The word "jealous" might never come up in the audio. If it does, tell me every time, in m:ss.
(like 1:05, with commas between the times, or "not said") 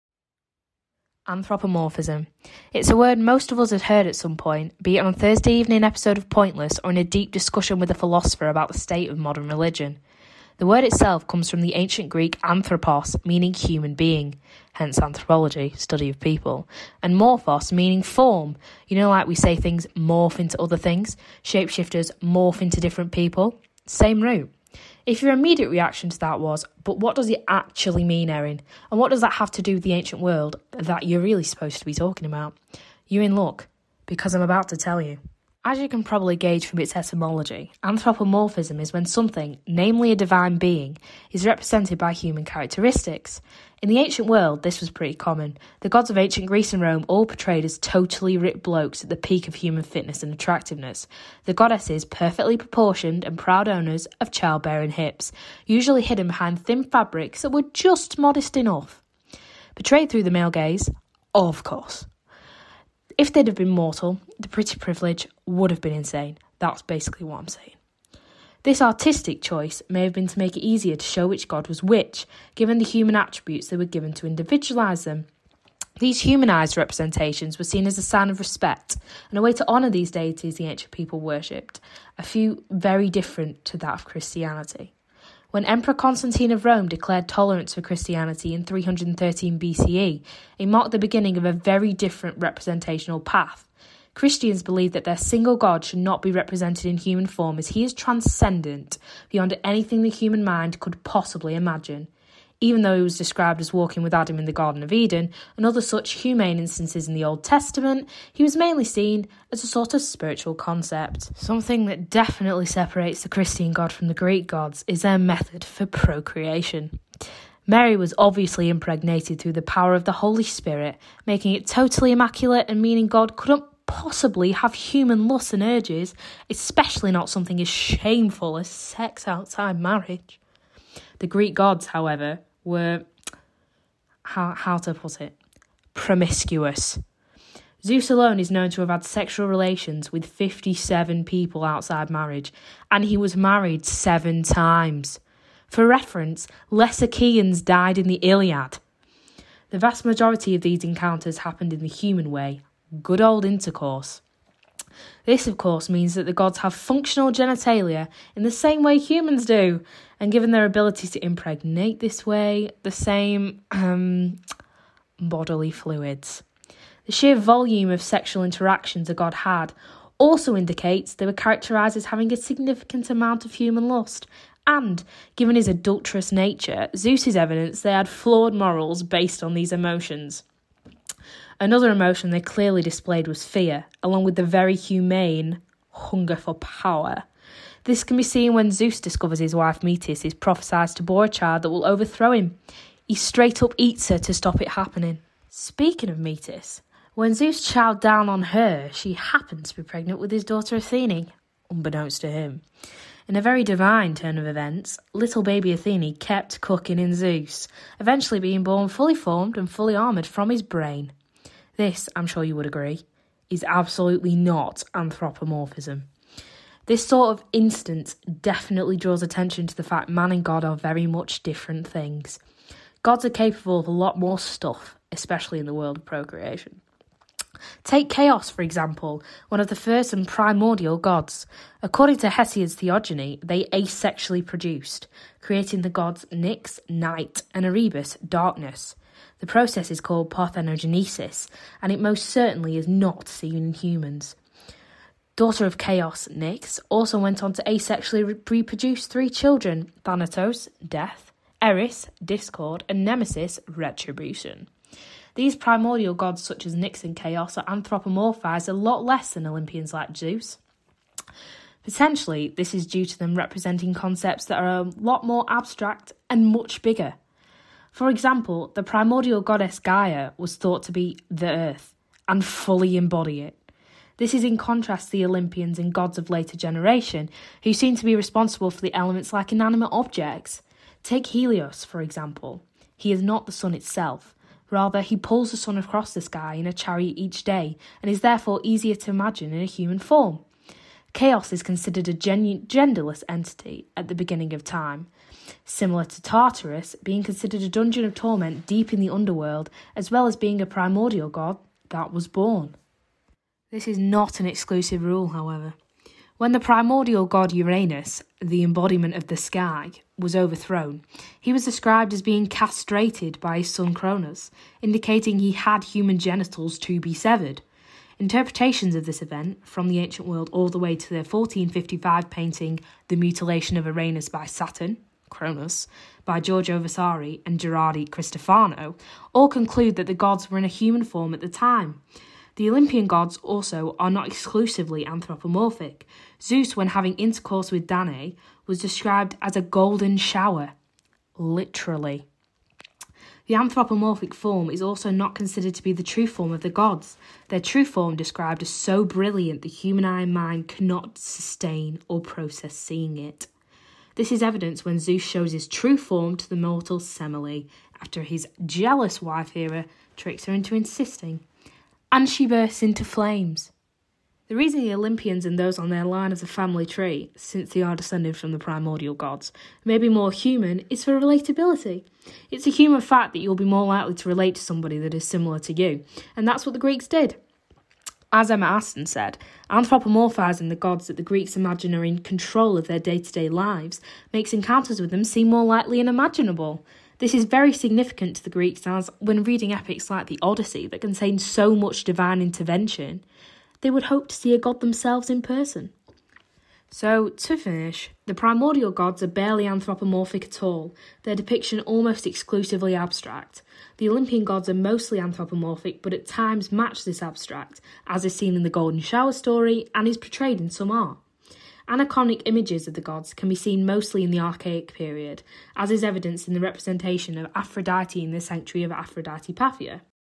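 5:58.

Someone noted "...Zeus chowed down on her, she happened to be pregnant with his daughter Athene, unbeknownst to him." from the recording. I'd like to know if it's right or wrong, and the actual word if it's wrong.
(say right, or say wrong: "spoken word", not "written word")
right.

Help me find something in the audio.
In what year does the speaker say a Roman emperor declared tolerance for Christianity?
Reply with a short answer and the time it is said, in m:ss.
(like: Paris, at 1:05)
313 BCE, at 1:28.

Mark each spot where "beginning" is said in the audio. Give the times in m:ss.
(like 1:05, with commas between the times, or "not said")
1:30, 4:54.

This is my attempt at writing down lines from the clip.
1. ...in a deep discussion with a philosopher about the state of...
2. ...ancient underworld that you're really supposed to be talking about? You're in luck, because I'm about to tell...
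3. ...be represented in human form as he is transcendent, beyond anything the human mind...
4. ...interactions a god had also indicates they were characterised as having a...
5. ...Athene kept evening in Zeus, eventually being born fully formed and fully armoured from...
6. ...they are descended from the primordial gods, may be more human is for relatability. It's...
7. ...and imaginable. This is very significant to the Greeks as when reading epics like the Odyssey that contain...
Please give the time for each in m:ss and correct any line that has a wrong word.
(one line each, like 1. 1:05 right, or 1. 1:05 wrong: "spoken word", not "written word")
1. 0:06 right
2. 0:29 wrong: "world", not "underworld"
3. 1:36 right
4. 2:48 right
5. 3:25 wrong: "cooking", not "evening"
6. 6:07 right
7. 6:26 right.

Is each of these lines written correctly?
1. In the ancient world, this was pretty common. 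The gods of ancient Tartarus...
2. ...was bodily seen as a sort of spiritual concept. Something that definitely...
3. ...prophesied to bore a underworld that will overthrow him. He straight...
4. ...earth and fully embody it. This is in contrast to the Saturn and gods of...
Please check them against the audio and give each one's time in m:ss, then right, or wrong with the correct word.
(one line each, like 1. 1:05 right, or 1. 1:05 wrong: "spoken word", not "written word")
1. 0:43 wrong: "Greece", not "Tartarus"
2. 1:48 wrong: "mainly", not "bodily"
3. 3:10 wrong: "child", not "underworld"
4. 4:31 wrong: "Olympians", not "Saturn".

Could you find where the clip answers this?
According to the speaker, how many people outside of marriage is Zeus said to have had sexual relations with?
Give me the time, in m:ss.
2:20.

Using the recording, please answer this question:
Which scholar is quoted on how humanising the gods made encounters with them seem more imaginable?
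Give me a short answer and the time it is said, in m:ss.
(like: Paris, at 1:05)
Emma Aston, at 6:18.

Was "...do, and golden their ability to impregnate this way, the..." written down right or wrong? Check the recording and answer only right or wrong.
wrong.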